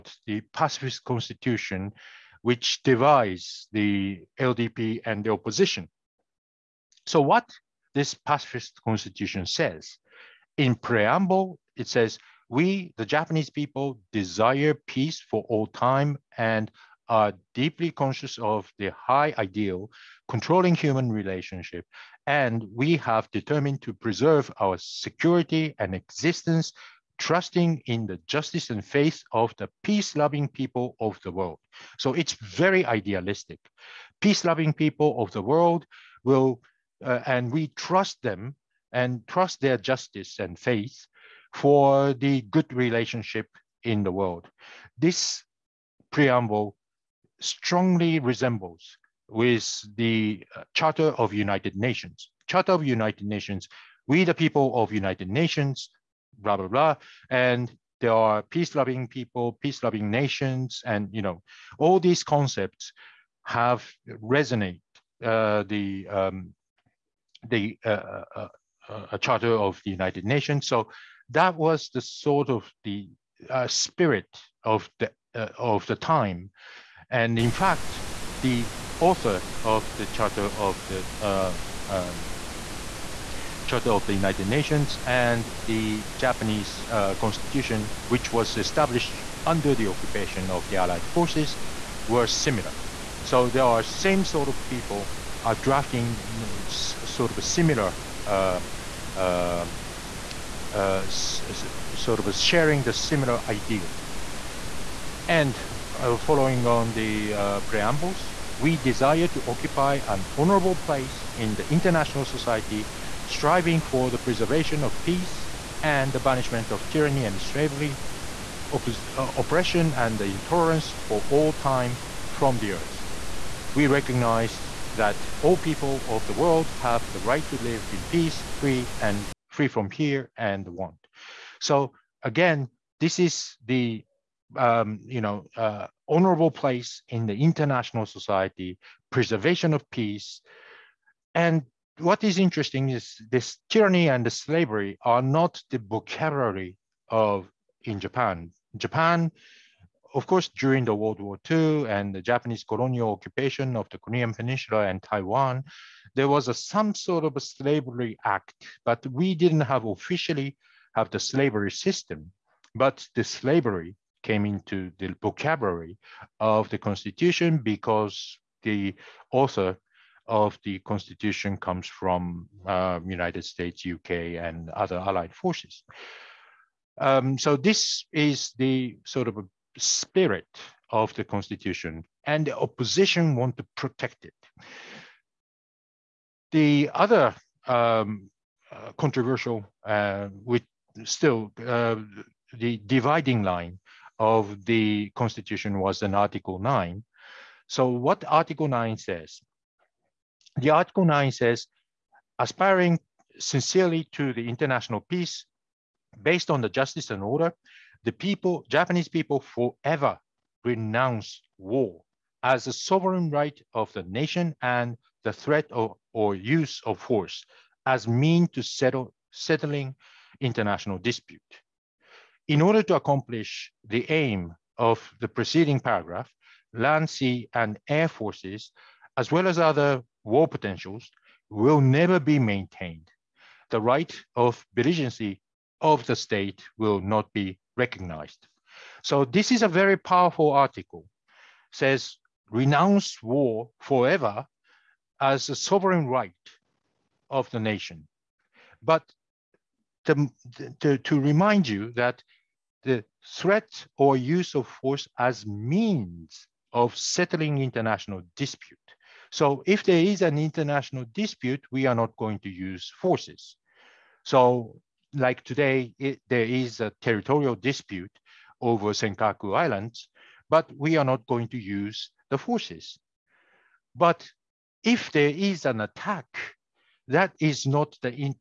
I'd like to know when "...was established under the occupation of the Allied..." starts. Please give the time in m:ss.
1:28.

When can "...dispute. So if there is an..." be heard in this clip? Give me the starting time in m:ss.
4:18.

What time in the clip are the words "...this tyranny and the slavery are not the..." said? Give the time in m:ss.
2:23.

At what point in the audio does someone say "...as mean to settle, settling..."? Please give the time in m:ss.
3:37.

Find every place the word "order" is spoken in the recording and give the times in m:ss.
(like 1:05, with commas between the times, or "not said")
3:27, 3:42.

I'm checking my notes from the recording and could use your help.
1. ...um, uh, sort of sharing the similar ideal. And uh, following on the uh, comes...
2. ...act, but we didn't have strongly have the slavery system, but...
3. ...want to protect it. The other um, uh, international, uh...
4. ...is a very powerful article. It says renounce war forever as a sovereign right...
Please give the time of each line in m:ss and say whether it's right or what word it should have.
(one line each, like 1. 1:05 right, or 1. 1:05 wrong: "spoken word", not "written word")
1. 1:39 wrong: "preambles", not "comes"
2. 2:38 wrong: "officially", not "strongly"
3. 3:03 wrong: "controversial", not "international"
4. 3:59 right.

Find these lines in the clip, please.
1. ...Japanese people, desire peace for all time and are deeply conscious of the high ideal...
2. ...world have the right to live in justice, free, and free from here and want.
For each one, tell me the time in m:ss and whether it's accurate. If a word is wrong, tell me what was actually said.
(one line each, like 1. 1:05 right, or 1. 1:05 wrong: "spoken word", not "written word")
1. 0:13 right
2. 2:06 wrong: "peace", not "justice".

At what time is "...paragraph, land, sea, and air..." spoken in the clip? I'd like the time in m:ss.
3:45.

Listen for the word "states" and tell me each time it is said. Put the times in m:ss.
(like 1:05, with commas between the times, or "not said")
2:53, 3:56.